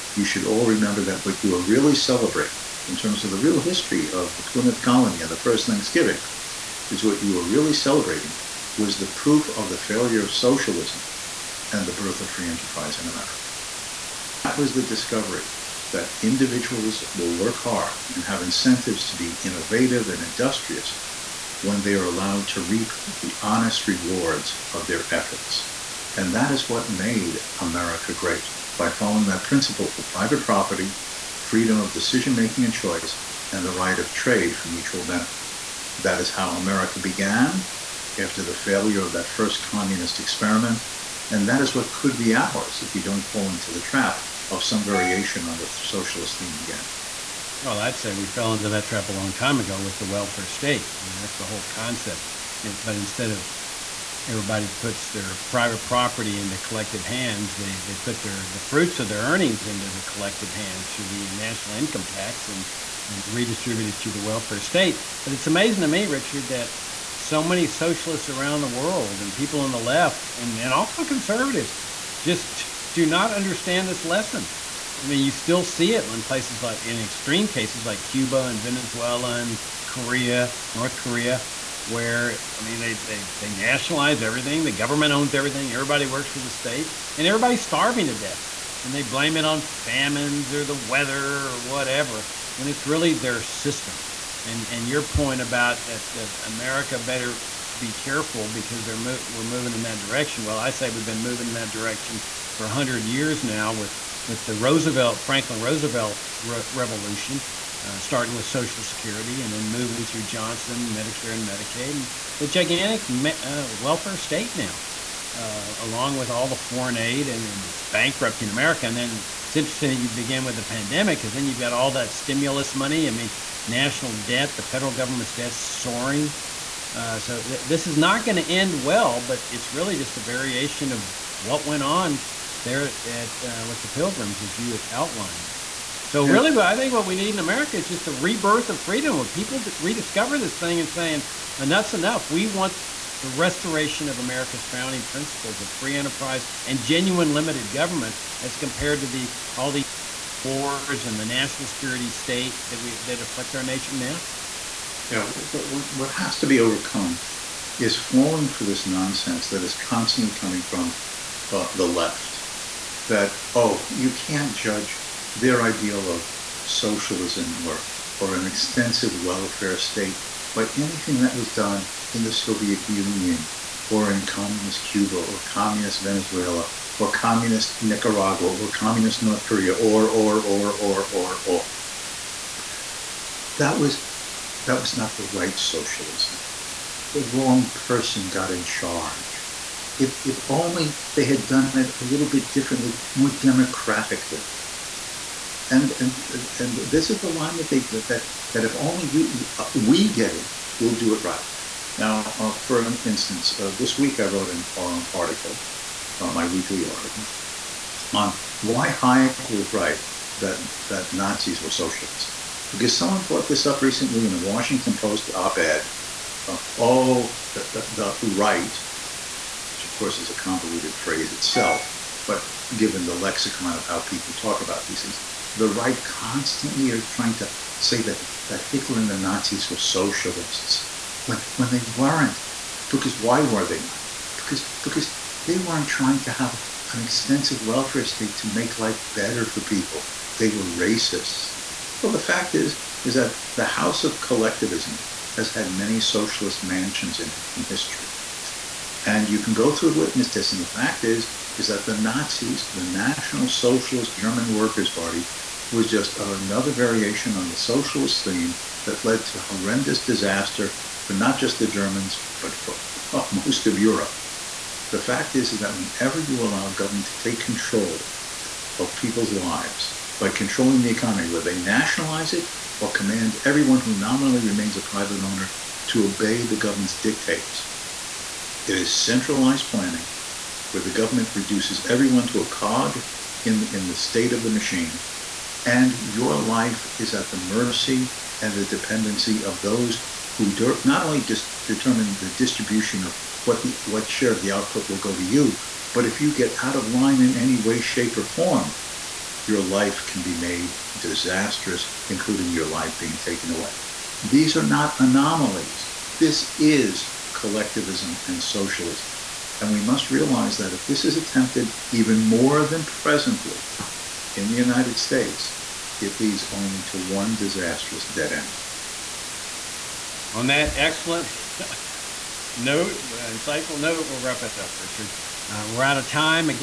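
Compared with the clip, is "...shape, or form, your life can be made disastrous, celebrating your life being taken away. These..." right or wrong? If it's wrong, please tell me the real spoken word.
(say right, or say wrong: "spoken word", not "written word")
wrong: "including", not "celebrating".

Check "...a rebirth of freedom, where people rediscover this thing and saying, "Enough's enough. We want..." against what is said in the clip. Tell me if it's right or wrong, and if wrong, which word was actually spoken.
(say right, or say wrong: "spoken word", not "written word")
right.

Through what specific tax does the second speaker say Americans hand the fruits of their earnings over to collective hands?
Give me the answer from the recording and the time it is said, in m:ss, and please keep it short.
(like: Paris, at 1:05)
national income tax, at 1:01.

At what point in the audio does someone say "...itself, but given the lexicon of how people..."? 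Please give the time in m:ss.
3:41.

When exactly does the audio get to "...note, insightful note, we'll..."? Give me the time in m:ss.
5:22.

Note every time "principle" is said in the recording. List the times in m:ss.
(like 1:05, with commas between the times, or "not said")
0:29, 2:25.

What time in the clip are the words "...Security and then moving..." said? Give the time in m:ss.
1:48.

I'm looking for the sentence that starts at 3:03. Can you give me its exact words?
That was that was not the right socialism.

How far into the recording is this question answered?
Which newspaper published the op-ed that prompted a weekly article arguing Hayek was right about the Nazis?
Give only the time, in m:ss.
3:34.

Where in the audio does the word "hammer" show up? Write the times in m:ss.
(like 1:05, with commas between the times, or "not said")
not said.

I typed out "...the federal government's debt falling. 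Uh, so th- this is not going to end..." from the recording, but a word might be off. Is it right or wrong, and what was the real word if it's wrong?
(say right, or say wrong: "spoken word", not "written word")
wrong: "soaring", not "falling".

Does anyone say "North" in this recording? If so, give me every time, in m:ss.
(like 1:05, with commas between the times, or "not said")
1:20, 2:59.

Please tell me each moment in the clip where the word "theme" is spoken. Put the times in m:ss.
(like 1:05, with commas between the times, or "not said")
0:46, 4:18.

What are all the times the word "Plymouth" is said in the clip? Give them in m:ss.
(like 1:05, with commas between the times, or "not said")
0:04.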